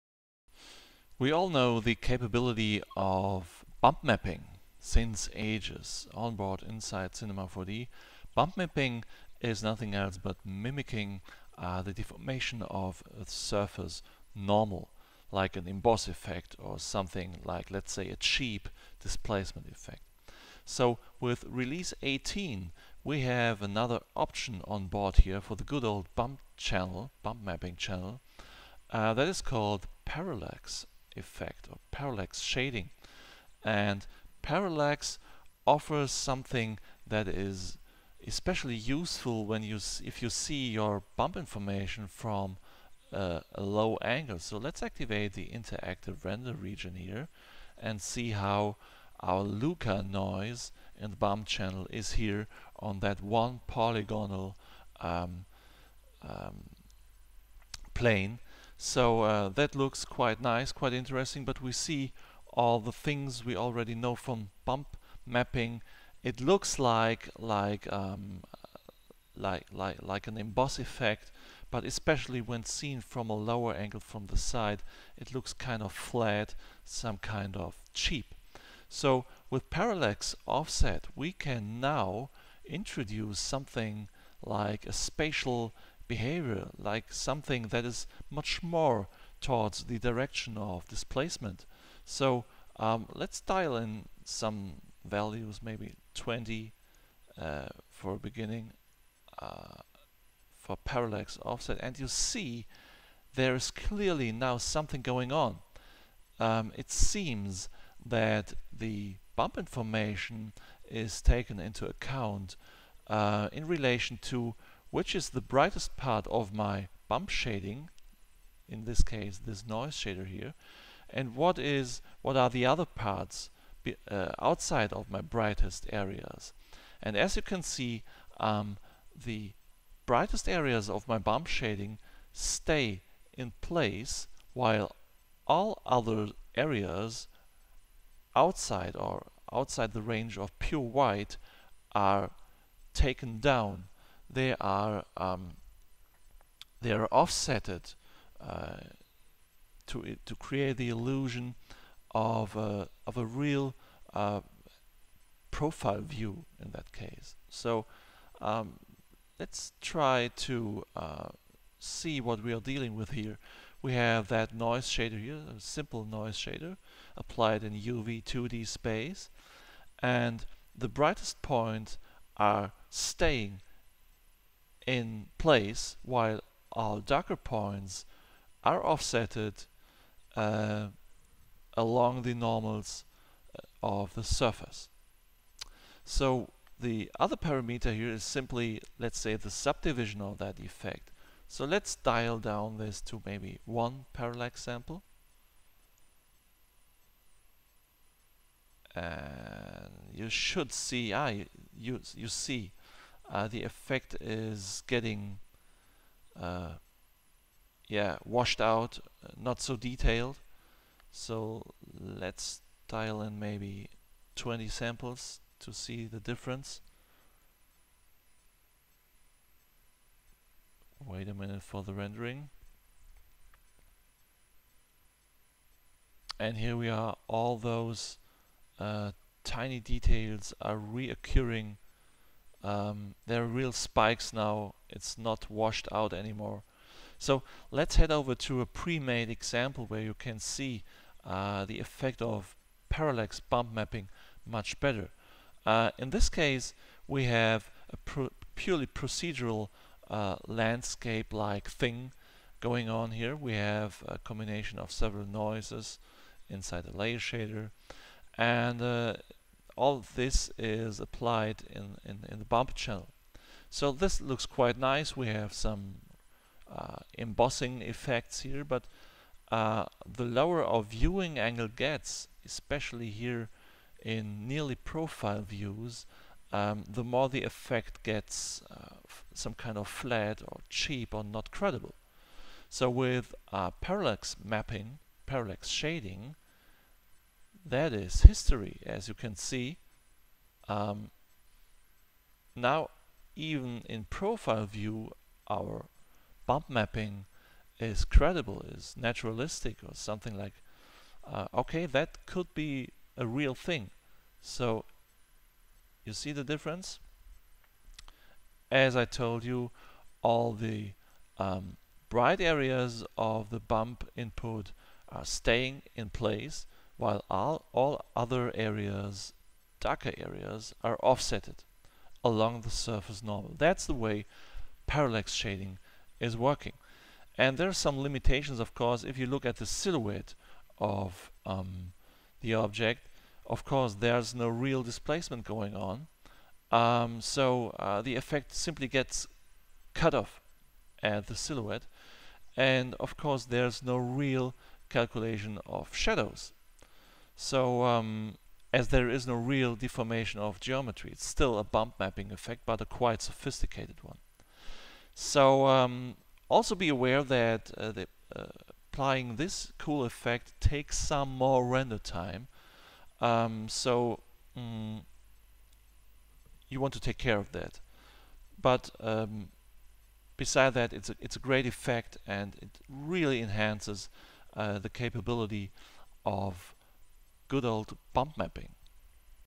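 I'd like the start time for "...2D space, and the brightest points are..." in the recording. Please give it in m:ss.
2:48.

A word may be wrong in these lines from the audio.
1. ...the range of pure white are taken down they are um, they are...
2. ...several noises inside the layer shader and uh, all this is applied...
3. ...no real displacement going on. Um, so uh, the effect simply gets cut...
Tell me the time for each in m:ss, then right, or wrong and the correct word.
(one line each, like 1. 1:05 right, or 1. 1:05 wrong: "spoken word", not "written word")
1. 2:19 right
2. 4:14 right
3. 5:34 right.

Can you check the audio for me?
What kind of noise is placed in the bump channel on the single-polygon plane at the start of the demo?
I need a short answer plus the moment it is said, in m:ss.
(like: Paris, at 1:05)
Luka noise, at 0:49.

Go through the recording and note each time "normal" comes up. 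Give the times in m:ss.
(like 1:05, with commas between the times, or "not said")
0:14, 3:02, 5:23.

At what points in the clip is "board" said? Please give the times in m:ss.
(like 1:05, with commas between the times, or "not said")
0:06, 0:24.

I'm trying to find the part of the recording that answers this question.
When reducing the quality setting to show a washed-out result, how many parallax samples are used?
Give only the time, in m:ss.
3:13.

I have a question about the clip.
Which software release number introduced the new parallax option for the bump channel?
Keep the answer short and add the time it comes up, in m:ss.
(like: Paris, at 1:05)
18, at 0:21.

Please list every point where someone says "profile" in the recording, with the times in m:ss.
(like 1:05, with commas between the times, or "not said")
2:35, 4:34, 4:54.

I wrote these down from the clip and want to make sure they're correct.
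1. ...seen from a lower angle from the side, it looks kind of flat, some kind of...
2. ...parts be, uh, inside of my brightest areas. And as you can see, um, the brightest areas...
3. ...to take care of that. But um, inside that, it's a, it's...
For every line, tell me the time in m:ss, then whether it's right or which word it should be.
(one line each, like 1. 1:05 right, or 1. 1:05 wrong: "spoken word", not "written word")
1. 1:12 right
2. 2:02 wrong: "outside", not "inside"
3. 6:06 wrong: "beside", not "inside".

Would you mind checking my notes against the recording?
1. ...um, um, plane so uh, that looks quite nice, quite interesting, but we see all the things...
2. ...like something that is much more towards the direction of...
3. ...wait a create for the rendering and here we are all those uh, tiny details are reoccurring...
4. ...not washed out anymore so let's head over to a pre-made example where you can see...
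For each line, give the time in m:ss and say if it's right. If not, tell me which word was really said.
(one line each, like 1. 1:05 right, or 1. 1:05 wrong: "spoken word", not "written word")
1. 0:54 right
2. 1:26 right
3. 3:41 wrong: "minute", not "create"
4. 3:55 right.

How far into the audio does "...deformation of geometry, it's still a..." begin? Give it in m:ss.
5:49.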